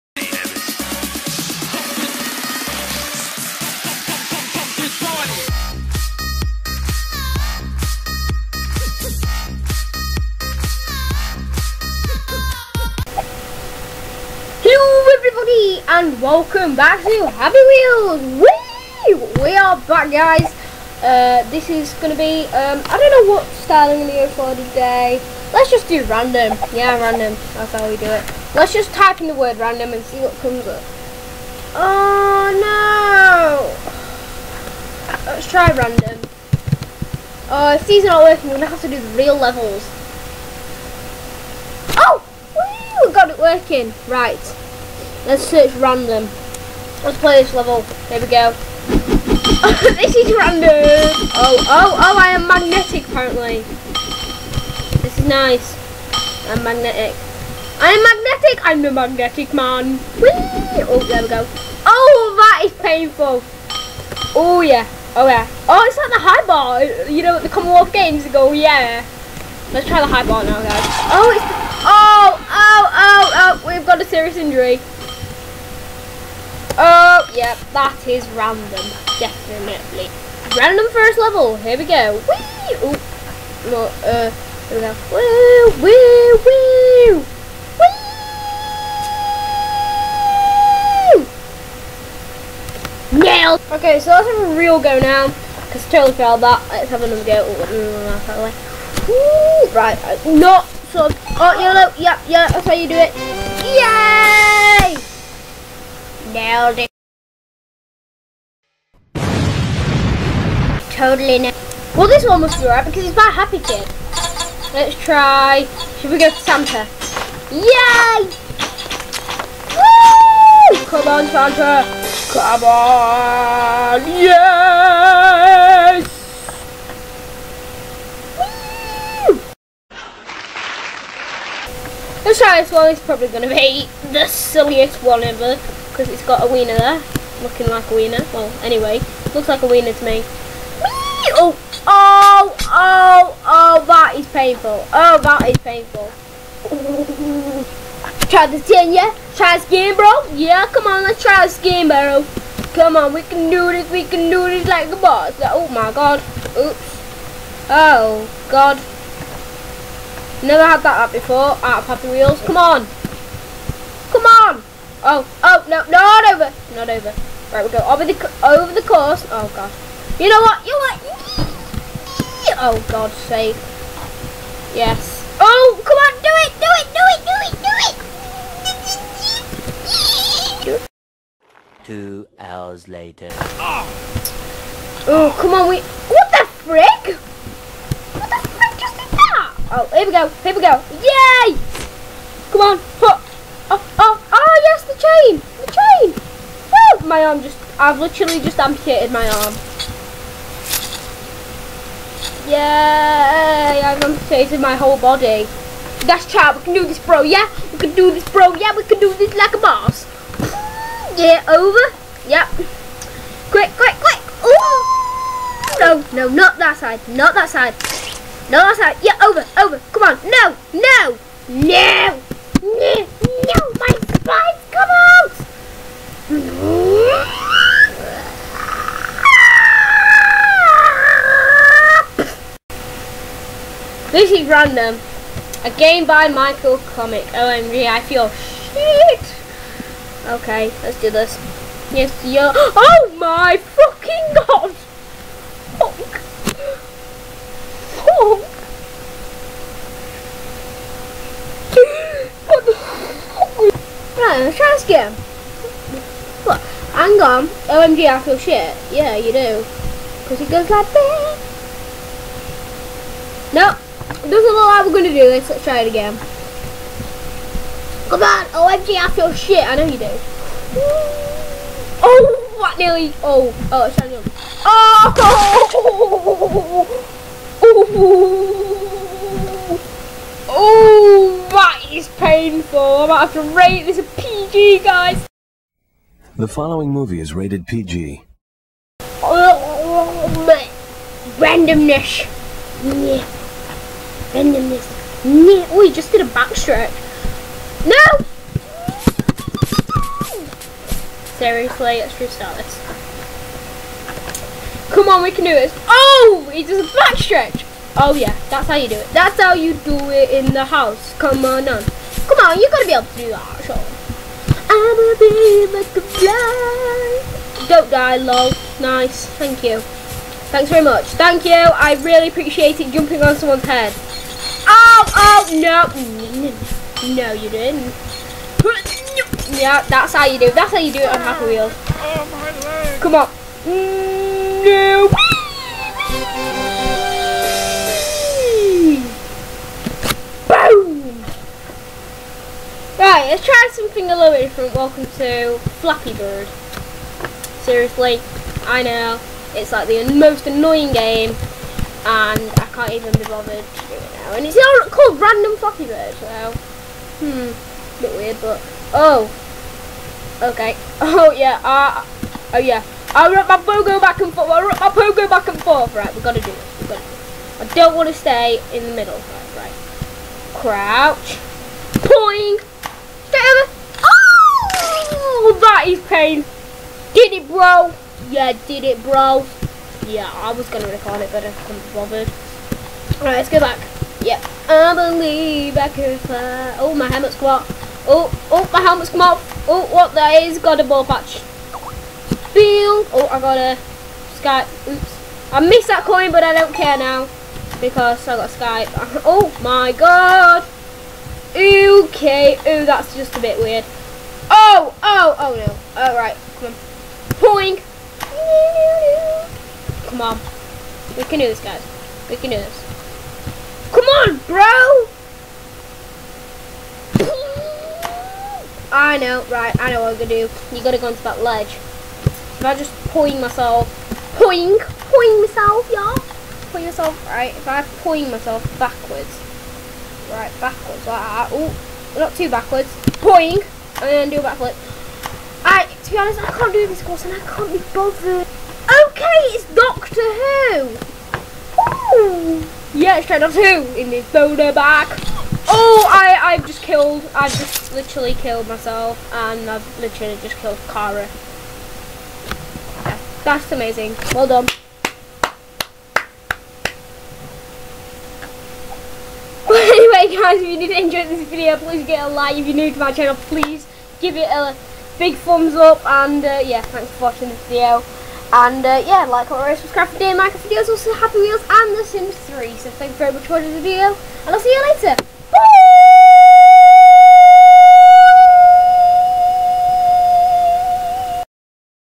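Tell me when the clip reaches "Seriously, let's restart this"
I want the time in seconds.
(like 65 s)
301 s.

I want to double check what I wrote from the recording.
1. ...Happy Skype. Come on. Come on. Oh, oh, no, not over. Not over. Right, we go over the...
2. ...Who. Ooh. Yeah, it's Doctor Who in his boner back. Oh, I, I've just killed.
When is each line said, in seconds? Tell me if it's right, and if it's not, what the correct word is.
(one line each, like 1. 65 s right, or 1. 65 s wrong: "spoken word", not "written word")
1. 161 s wrong: "Wheels", not "Skype"
2. 440 s right.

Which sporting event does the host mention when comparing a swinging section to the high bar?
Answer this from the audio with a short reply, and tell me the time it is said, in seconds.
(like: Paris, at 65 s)
Commonwealth Games, at 67 s.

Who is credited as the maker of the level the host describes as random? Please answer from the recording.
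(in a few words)
Michael Comic.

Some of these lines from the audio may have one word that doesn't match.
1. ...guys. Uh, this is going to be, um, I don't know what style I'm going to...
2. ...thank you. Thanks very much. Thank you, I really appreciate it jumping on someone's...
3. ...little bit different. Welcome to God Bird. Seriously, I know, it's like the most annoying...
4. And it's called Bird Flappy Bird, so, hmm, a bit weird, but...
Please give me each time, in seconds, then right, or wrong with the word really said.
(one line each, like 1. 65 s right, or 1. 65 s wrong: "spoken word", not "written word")
1. 20 s right
2. 319 s right
3. 344 s wrong: "Flappy", not "God"
4. 354 s wrong: "Random", not "Bird".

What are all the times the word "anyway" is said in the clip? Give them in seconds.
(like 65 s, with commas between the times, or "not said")
138 s.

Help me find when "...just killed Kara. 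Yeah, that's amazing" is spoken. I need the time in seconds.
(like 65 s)
450 s.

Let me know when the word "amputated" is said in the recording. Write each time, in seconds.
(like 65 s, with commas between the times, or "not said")
198 s, 204 s.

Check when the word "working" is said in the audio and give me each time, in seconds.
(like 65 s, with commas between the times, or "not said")
38 s, 43 s.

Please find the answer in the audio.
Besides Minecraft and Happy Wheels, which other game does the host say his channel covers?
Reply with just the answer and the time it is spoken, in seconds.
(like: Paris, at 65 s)
The Sims 3, at 471 s.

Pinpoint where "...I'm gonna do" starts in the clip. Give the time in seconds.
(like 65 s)
420 s.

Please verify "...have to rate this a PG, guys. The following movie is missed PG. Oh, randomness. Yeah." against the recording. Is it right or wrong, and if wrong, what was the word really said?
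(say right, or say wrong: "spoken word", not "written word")
wrong: "rated", not "missed".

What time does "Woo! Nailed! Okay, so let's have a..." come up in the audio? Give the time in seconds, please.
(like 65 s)
93 s.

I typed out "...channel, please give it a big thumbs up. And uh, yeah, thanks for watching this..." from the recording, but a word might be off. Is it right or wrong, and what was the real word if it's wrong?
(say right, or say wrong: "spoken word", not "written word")
right.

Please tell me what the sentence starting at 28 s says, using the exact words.
Let's just type in the word random and see what comes up.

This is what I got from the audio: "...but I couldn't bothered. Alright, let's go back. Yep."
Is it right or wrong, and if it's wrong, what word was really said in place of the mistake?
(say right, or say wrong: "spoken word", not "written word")
right.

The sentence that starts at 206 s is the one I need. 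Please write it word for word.
That's chat, we can do this, bro, yeah?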